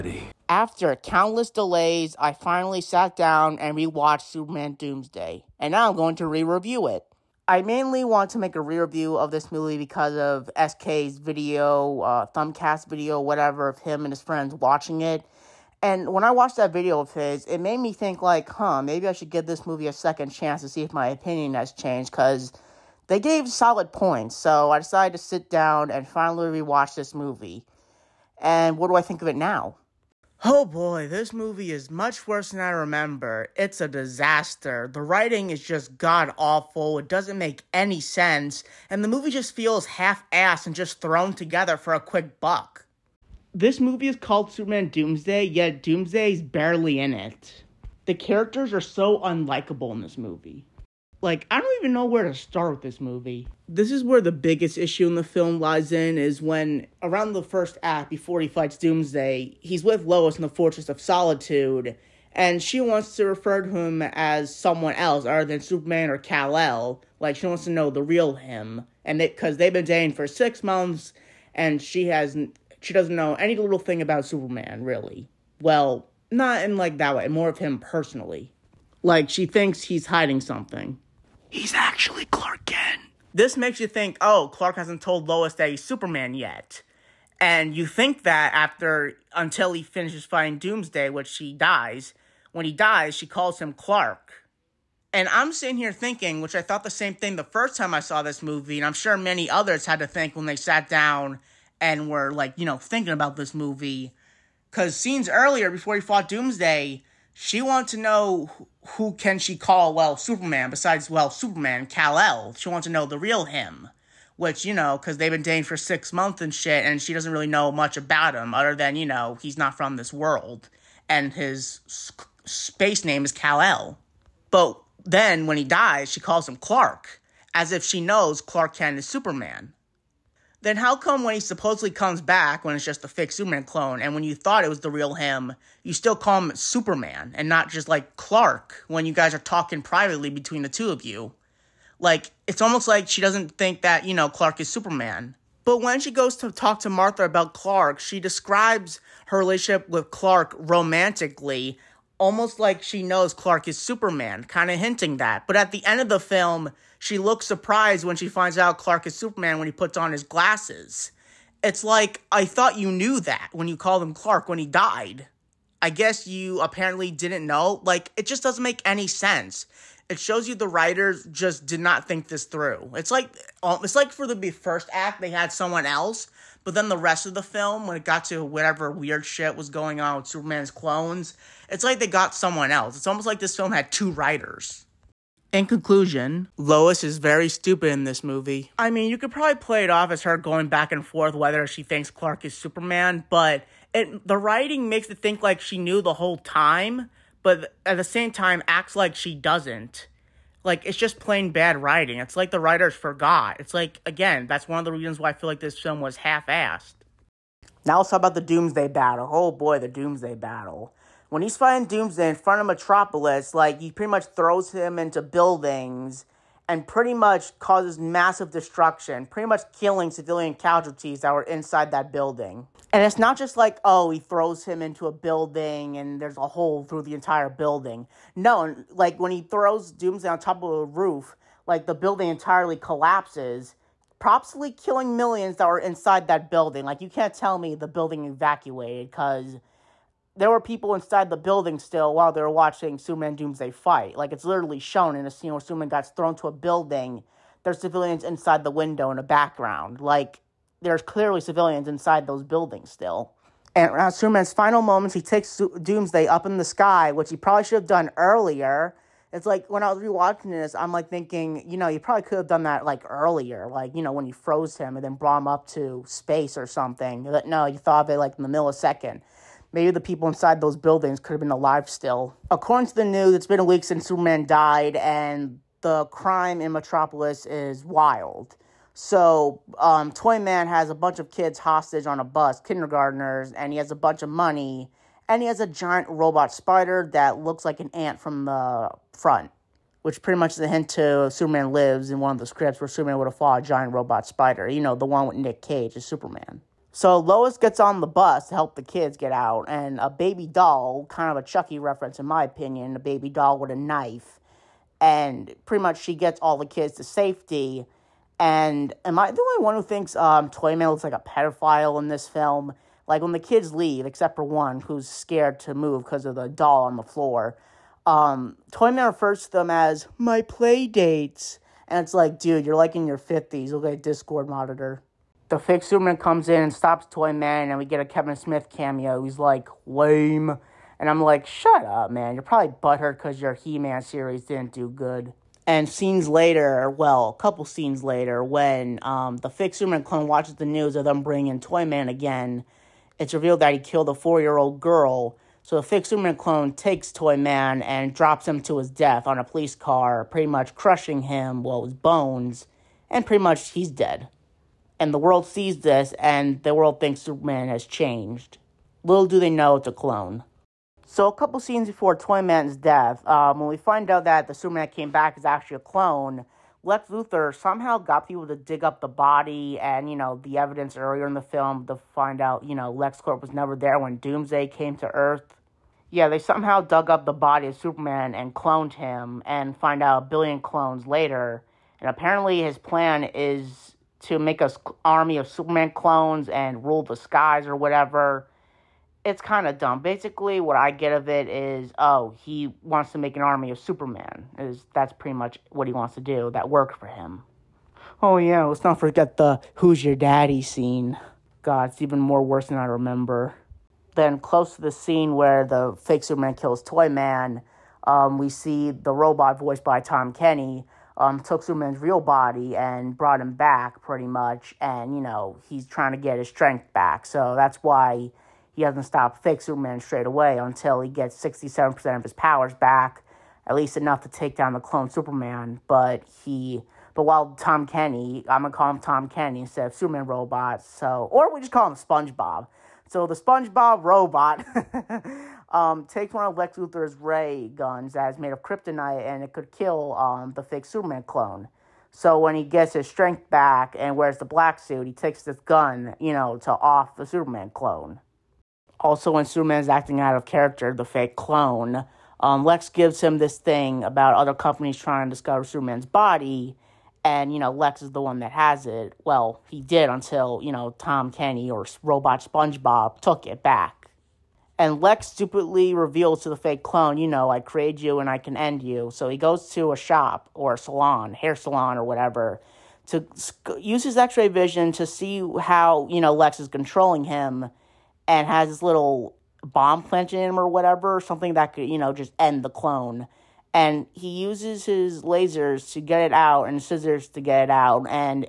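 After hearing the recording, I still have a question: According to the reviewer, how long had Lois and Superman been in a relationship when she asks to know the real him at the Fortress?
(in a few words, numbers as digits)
6 months.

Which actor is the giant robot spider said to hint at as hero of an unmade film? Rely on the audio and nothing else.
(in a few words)
Nick Cage.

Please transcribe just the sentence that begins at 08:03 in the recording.
And he uses his lasers to get it out and scissors to get it out.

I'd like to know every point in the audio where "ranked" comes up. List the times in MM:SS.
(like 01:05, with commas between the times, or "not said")
not said.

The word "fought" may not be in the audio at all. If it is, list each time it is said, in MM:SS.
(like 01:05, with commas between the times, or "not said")
01:46, 04:53.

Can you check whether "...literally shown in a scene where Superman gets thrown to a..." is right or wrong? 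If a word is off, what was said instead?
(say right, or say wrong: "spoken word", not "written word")
right.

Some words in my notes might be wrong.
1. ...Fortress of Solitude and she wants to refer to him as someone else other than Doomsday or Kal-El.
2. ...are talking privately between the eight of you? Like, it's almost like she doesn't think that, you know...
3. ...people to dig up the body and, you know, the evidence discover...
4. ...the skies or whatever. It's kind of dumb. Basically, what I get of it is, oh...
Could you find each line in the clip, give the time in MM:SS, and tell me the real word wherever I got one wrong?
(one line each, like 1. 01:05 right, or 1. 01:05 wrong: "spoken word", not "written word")
1. 01:00 wrong: "Superman", not "Doomsday"
2. 02:19 wrong: "two", not "eight"
3. 06:08 wrong: "earlier", not "discover"
4. 06:27 right.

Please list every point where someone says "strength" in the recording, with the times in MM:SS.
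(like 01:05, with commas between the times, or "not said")
06:56, 07:23.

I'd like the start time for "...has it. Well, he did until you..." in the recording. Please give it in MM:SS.
07:38.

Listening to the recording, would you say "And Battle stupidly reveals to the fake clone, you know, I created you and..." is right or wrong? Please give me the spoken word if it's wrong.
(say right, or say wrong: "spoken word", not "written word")
wrong: "Lex", not "Battle".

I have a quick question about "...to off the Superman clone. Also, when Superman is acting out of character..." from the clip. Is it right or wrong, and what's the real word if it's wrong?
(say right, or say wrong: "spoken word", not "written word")
right.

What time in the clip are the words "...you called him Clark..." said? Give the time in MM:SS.
02:43.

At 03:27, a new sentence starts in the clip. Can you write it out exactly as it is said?
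Now let's talk about the Doomsday Battle.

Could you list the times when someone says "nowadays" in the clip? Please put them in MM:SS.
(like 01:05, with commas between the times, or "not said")
not said.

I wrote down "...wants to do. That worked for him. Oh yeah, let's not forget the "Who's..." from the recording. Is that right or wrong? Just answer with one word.
right.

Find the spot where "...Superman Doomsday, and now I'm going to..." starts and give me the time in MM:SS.
00:04.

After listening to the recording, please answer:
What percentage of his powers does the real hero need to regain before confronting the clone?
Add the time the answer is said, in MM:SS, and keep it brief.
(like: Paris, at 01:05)
67%, at 07:01.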